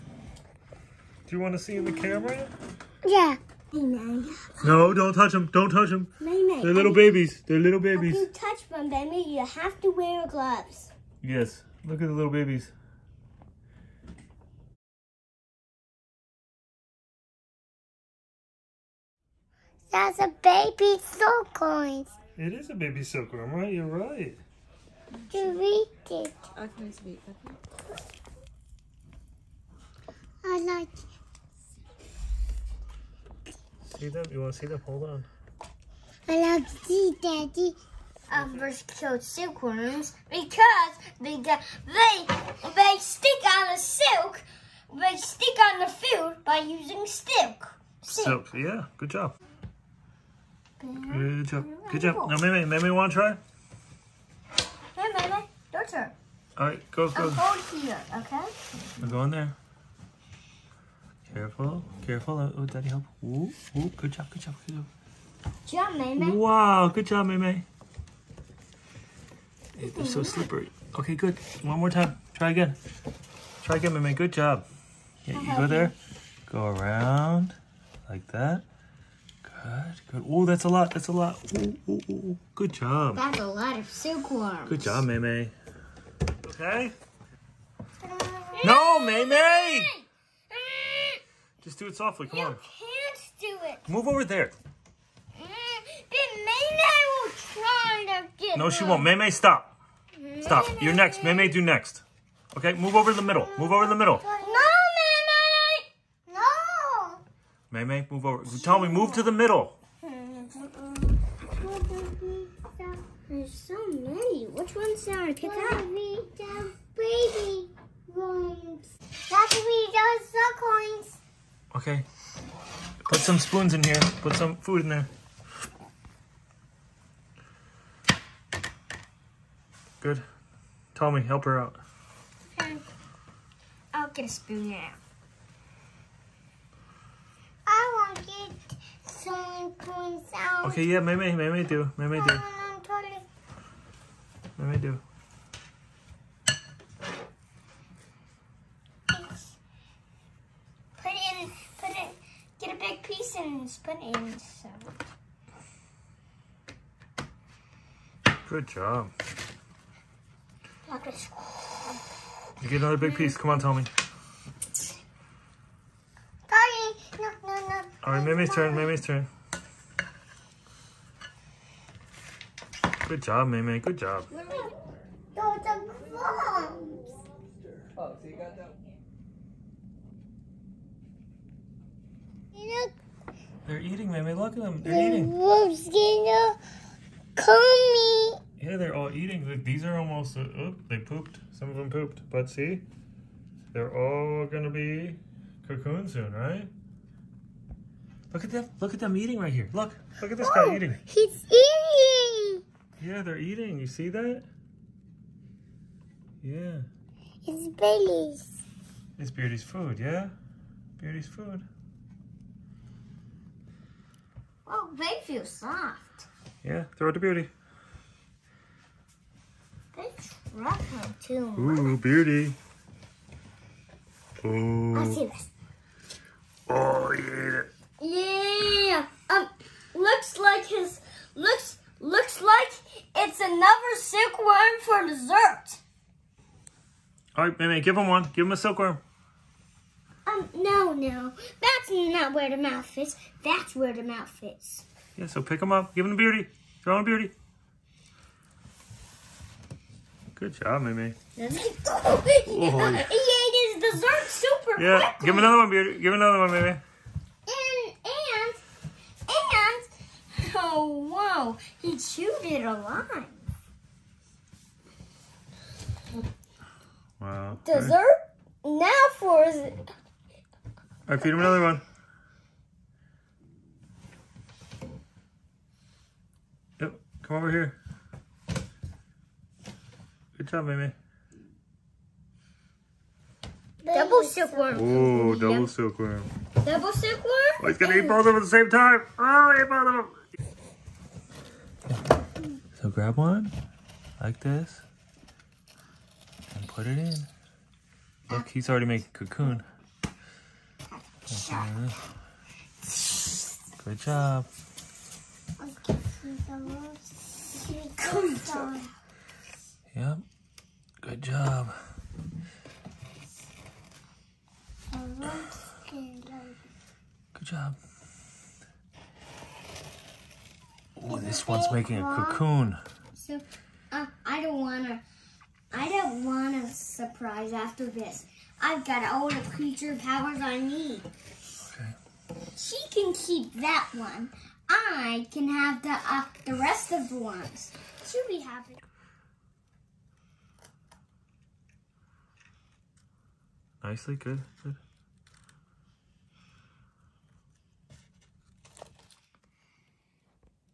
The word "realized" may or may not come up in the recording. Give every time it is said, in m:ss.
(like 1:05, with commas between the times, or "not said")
not said.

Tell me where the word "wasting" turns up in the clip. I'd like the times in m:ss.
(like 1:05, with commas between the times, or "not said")
not said.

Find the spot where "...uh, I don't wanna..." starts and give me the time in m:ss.
5:23.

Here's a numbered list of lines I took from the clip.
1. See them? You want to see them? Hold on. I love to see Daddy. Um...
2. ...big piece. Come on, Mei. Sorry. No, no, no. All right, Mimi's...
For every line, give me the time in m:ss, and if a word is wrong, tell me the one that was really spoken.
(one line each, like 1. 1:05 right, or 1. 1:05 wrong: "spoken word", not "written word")
1. 0:33 right
2. 2:42 wrong: "Tommy", not "Mei".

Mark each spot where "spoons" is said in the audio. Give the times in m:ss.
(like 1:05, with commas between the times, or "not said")
2:03, 2:14, 2:19.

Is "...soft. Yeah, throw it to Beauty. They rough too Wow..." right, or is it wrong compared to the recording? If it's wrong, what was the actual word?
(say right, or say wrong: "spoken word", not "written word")
wrong: "Ooh", not "Wow".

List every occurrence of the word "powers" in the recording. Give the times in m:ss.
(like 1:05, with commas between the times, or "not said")
5:29.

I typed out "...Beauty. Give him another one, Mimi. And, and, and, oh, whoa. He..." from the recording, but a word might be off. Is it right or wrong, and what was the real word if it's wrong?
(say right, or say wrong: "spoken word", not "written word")
right.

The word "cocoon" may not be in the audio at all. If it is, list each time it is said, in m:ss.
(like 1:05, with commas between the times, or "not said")
3:15, 4:59, 5:22.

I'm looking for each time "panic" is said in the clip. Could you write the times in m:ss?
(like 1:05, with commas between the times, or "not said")
not said.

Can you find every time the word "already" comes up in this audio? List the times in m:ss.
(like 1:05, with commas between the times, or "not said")
4:58.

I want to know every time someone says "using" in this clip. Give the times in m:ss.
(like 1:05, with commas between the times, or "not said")
0:46.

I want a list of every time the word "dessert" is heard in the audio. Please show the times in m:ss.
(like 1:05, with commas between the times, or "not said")
3:55, 4:13, 4:27.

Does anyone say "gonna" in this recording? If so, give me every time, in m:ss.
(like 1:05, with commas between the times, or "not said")
3:05, 3:14, 4:47.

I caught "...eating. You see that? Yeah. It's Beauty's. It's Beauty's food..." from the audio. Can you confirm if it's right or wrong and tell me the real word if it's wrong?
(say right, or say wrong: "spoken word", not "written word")
right.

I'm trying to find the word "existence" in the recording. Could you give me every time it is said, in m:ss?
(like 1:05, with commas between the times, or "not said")
not said.